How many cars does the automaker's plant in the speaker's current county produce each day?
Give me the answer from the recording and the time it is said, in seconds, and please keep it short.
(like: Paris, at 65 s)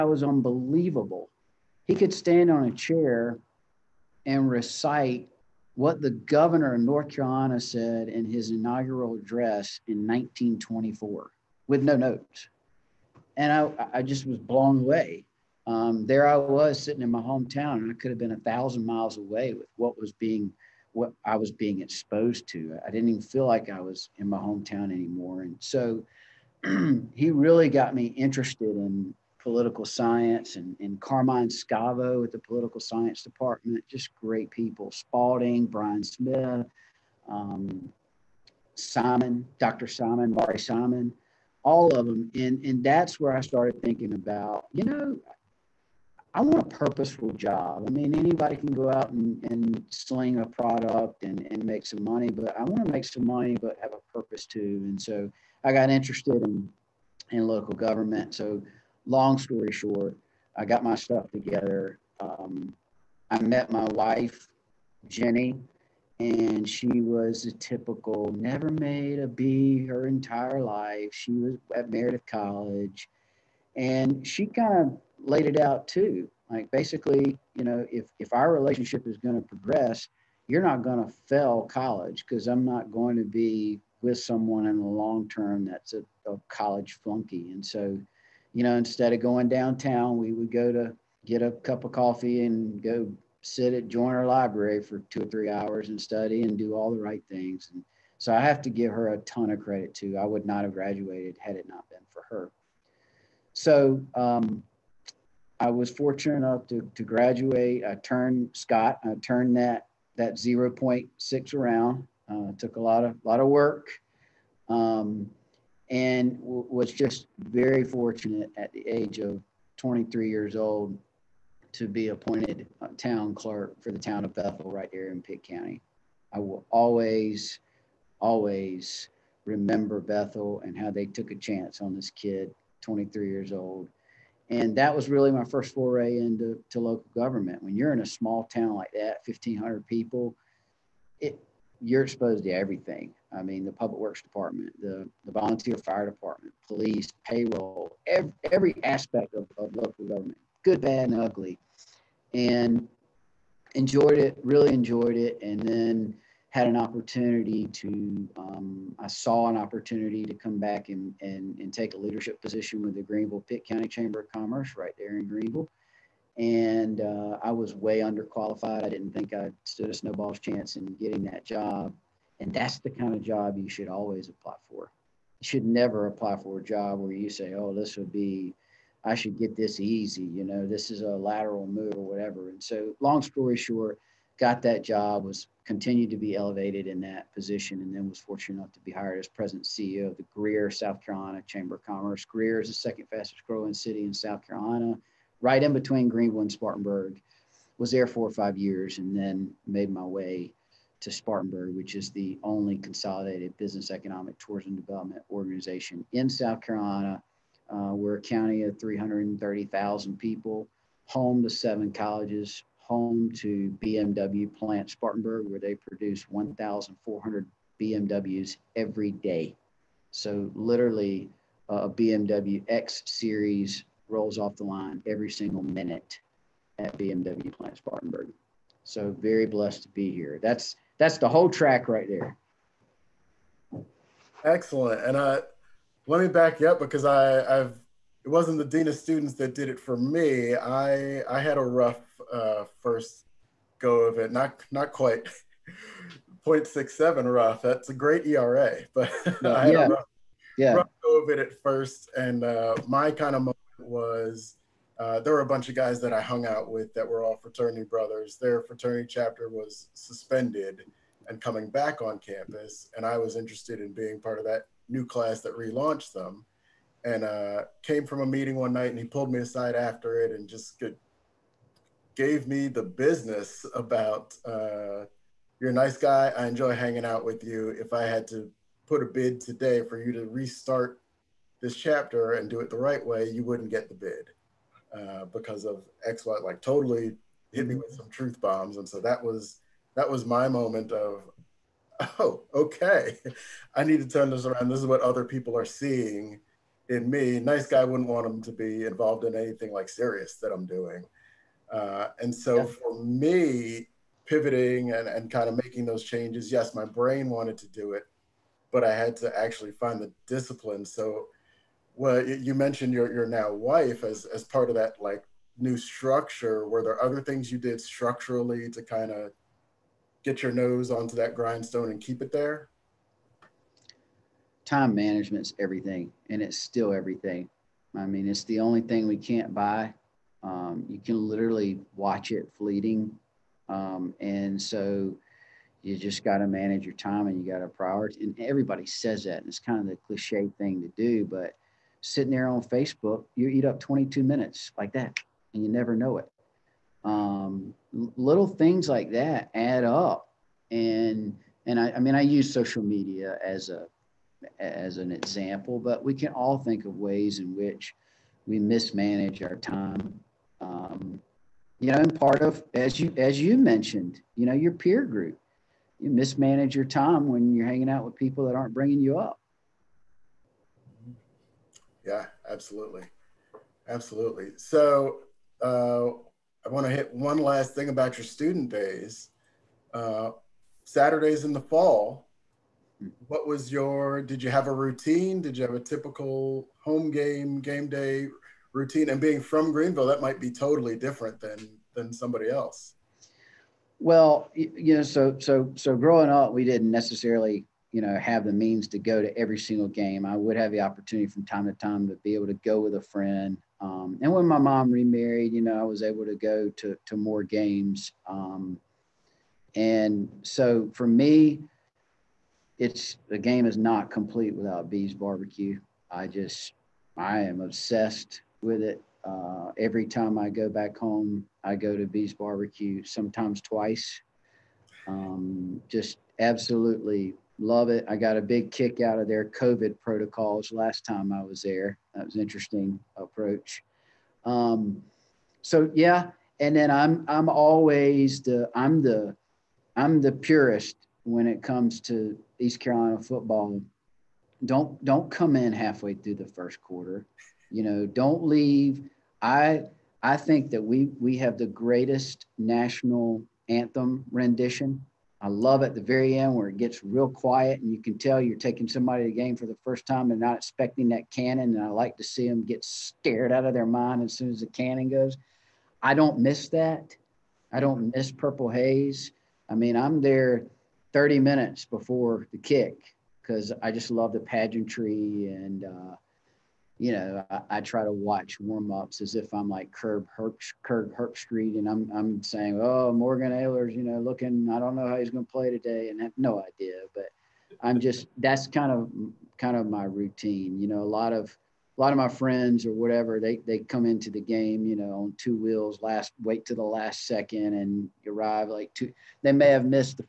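1,400, at 216 s.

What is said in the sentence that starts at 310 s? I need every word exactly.
So, well, you mentioned your, your now wife as, as part of that like new structure.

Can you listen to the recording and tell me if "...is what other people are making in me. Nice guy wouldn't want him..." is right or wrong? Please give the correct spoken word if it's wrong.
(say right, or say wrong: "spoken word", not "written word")
wrong: "seeing", not "making".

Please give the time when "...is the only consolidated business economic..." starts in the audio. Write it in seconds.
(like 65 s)
201 s.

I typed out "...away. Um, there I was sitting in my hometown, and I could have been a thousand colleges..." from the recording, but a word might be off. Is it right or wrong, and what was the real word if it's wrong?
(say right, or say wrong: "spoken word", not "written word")
wrong: "miles", not "colleges".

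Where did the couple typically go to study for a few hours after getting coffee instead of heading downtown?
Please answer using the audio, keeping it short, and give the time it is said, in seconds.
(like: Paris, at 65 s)
Joyner Library, at 93 s.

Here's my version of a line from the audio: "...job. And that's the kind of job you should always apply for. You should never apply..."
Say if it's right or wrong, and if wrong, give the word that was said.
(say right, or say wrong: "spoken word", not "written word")
right.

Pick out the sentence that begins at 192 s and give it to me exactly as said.
Greer is the second fastest growing city in South Carolina, right in between Greenville and Spartanburg.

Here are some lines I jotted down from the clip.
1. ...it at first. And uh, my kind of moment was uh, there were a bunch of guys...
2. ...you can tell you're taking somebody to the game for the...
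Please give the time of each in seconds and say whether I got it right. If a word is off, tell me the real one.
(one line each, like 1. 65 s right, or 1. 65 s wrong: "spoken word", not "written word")
1. 251 s right
2. 457 s right.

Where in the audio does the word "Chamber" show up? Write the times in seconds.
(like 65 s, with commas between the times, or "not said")
163 s, 191 s.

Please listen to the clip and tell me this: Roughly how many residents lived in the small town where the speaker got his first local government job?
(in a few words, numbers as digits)
1,500.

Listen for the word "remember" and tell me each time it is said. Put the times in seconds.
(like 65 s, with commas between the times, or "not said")
129 s.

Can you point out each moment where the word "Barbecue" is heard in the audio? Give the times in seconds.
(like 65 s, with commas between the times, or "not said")
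415 s, 422 s.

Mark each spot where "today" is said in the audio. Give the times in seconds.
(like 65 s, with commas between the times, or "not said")
279 s, 485 s.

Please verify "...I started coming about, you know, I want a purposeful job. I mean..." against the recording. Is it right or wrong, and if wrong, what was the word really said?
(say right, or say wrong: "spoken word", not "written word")
wrong: "thinking", not "coming".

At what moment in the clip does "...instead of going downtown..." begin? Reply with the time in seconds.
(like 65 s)
88 s.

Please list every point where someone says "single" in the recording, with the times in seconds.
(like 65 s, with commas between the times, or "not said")
225 s, 399 s.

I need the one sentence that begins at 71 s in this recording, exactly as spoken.
She was at Meredith College, and she kind of laid it out too.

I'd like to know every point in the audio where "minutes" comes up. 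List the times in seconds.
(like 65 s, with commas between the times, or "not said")
225 s, 344 s, 471 s.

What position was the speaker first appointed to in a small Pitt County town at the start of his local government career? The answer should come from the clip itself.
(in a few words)
Town clerk.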